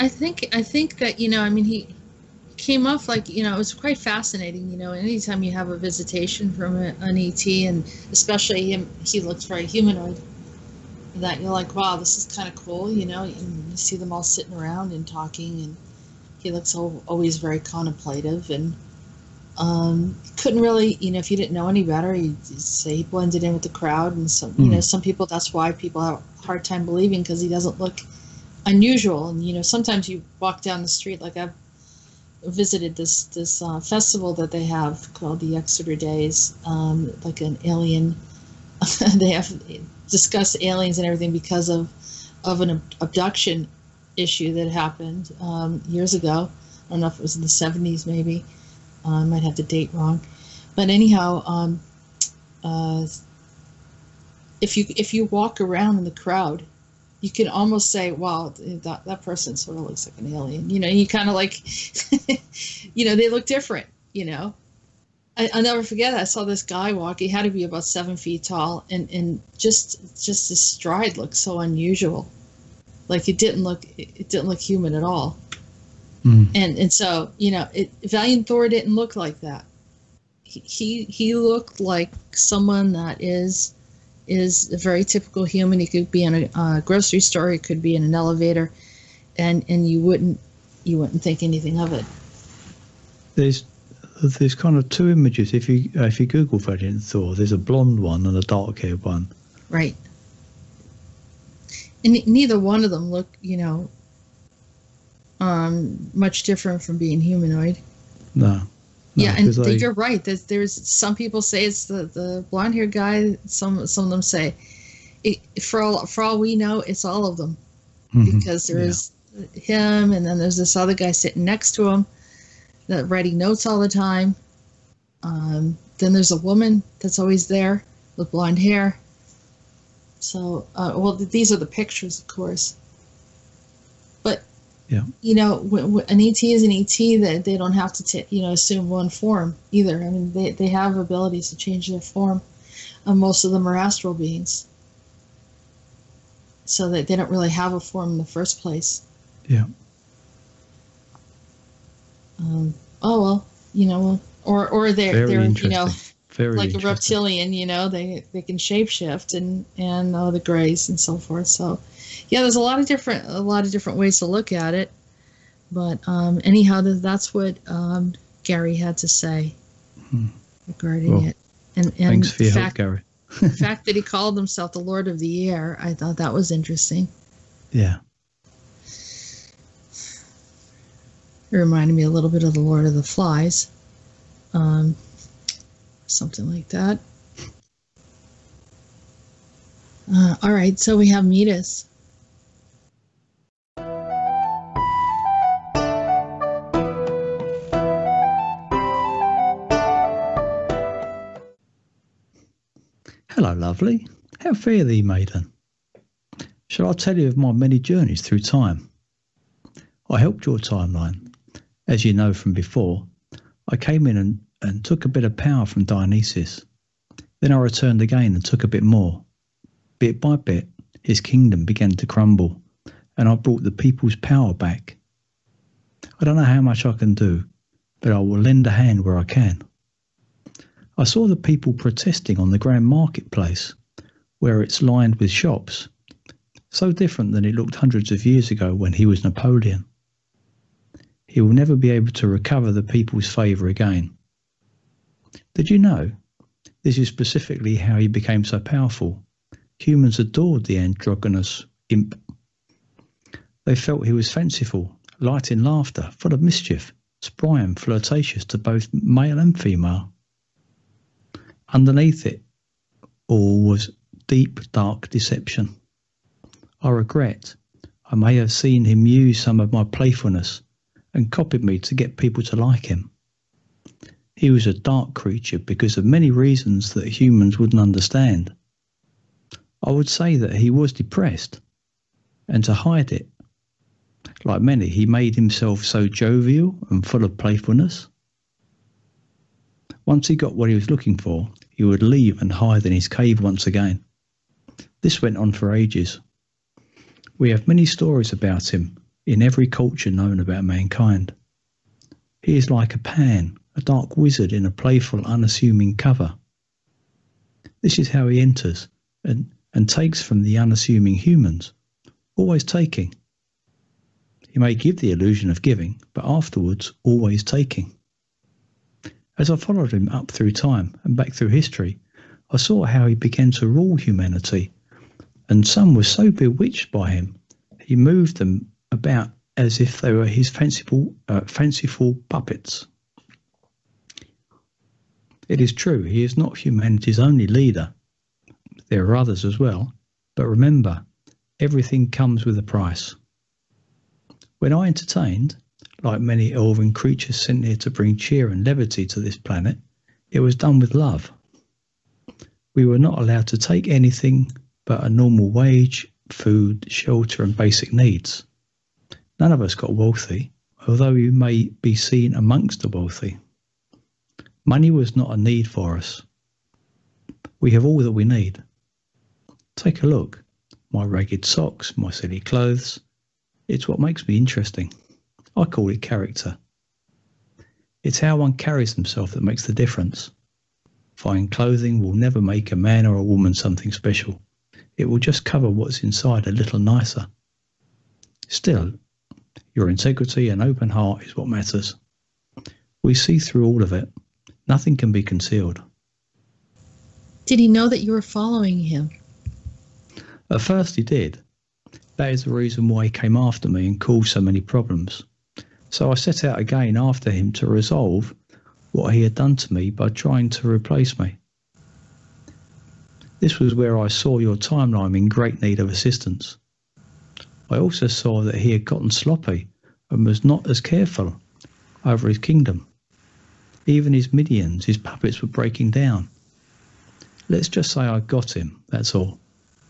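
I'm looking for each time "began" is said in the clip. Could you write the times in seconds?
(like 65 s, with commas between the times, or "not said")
221 s, 323 s.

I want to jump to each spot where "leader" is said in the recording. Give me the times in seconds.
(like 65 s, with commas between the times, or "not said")
337 s.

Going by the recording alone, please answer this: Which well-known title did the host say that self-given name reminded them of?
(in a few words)
Lord of the Flies.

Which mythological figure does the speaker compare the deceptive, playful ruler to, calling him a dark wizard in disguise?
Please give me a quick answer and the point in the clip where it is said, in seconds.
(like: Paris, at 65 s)
Pan, at 302 s.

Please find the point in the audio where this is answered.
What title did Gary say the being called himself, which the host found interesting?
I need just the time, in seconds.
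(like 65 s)
174 s.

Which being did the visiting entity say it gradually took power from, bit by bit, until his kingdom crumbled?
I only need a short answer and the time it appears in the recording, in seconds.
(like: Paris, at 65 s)
Dionysus, at 215 s.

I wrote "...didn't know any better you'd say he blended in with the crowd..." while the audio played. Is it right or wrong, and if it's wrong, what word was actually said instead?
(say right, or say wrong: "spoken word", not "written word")
right.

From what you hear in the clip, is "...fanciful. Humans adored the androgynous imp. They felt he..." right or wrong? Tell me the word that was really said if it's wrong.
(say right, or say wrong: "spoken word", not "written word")
wrong: "powerful", not "fanciful".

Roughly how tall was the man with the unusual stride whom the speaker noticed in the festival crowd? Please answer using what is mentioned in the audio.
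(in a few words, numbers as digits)
7 feet.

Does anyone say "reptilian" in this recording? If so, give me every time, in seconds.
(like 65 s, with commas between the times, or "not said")
156 s.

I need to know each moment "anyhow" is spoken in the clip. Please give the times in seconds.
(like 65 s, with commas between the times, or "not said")
50 s, 166 s.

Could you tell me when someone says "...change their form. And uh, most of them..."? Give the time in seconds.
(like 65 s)
141 s.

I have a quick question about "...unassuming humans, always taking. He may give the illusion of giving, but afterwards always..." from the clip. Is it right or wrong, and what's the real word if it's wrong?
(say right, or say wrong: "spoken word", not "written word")
right.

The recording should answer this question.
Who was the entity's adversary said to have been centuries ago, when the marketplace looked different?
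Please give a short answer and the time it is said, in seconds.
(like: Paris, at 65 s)
Napoleon, at 239 s.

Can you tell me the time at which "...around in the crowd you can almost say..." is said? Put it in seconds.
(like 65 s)
55 s.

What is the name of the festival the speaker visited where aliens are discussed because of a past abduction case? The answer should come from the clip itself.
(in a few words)
Exeter Days.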